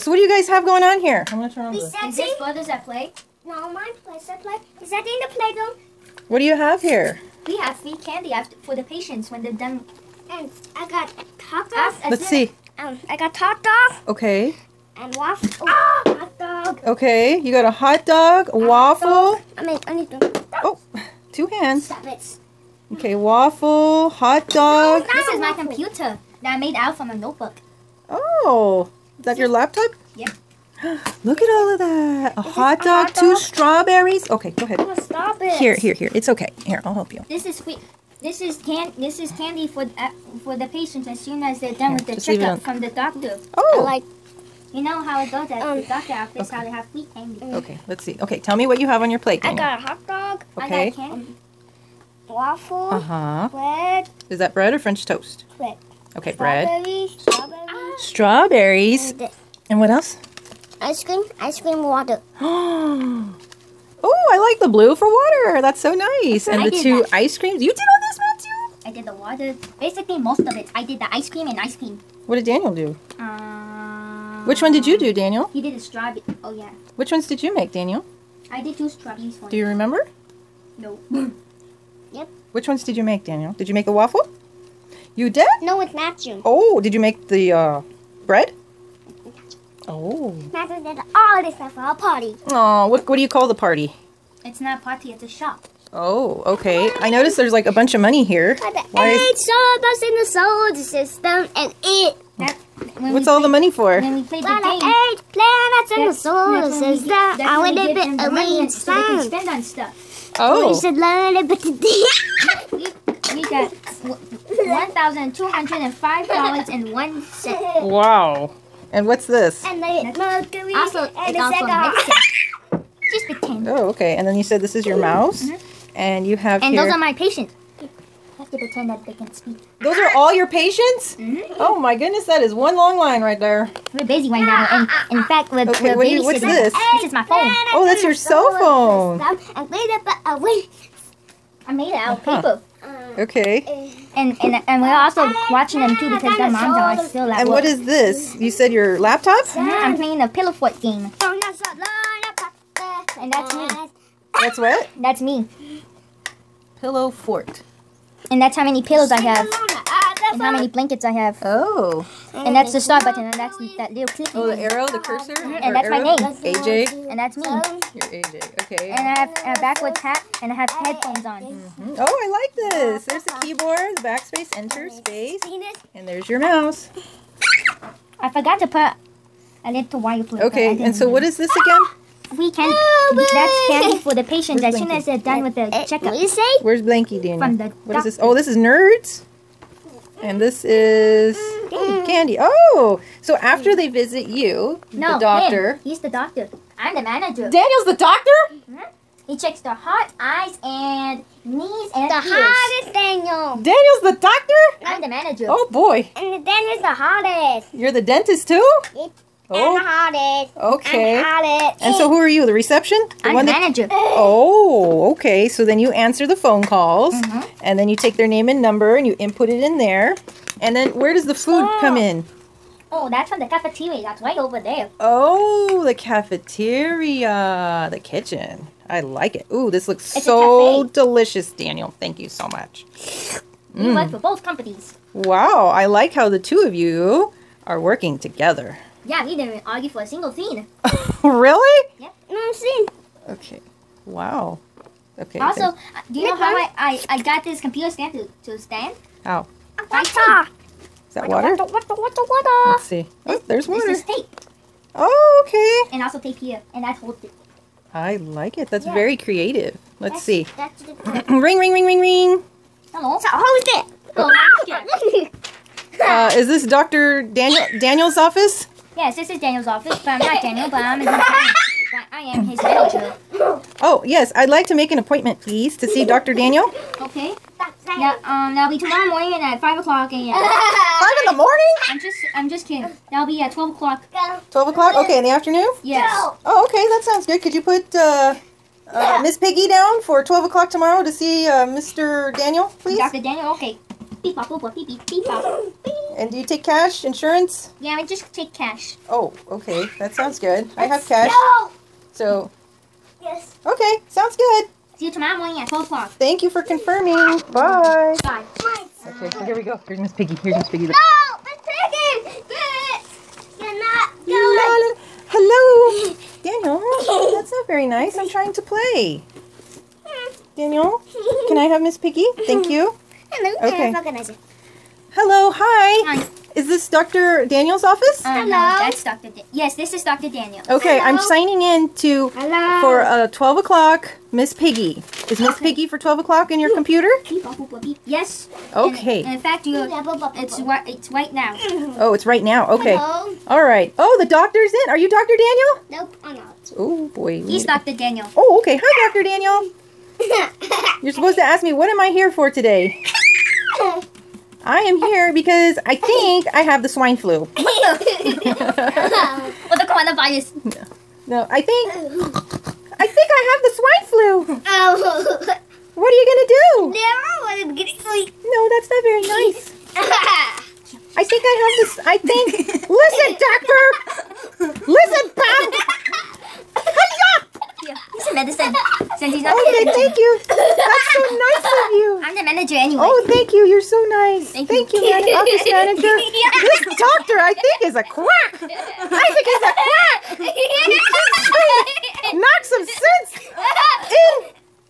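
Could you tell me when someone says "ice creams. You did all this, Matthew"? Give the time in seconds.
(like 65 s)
67 s.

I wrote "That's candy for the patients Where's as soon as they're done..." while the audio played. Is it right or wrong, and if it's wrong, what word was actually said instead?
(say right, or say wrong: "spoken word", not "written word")
right.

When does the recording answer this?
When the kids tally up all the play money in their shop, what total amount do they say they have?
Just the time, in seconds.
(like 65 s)
113 s.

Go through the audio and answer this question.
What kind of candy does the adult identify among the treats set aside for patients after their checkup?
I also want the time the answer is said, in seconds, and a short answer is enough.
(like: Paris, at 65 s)
Nerds, at 188 s.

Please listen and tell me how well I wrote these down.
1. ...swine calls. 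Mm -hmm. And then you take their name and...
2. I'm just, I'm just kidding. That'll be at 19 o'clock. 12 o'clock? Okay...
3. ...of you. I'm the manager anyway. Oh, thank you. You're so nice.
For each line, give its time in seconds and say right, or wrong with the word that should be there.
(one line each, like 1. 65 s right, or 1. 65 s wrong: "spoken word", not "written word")
1. 216 s wrong: "phone", not "swine"
2. 281 s wrong: "12", not "19"
3. 381 s right.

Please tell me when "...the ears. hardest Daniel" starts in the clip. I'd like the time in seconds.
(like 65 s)
202 s.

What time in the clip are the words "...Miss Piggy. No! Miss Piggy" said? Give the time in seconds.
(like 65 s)
310 s.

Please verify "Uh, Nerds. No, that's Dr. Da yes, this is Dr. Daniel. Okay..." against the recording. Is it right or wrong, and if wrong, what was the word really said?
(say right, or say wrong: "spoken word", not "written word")
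wrong: "Hello", not "Nerds".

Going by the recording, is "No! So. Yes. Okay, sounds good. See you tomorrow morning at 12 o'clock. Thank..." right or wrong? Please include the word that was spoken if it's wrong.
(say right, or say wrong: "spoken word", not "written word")
right.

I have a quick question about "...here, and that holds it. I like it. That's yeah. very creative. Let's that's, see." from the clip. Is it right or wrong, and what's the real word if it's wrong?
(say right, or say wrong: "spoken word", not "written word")
right.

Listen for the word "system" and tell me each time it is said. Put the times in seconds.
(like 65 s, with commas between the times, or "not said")
100 s, 106 s.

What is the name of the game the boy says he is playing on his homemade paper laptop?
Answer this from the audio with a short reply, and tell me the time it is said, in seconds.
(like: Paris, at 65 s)
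pillow fort game, at 150 s.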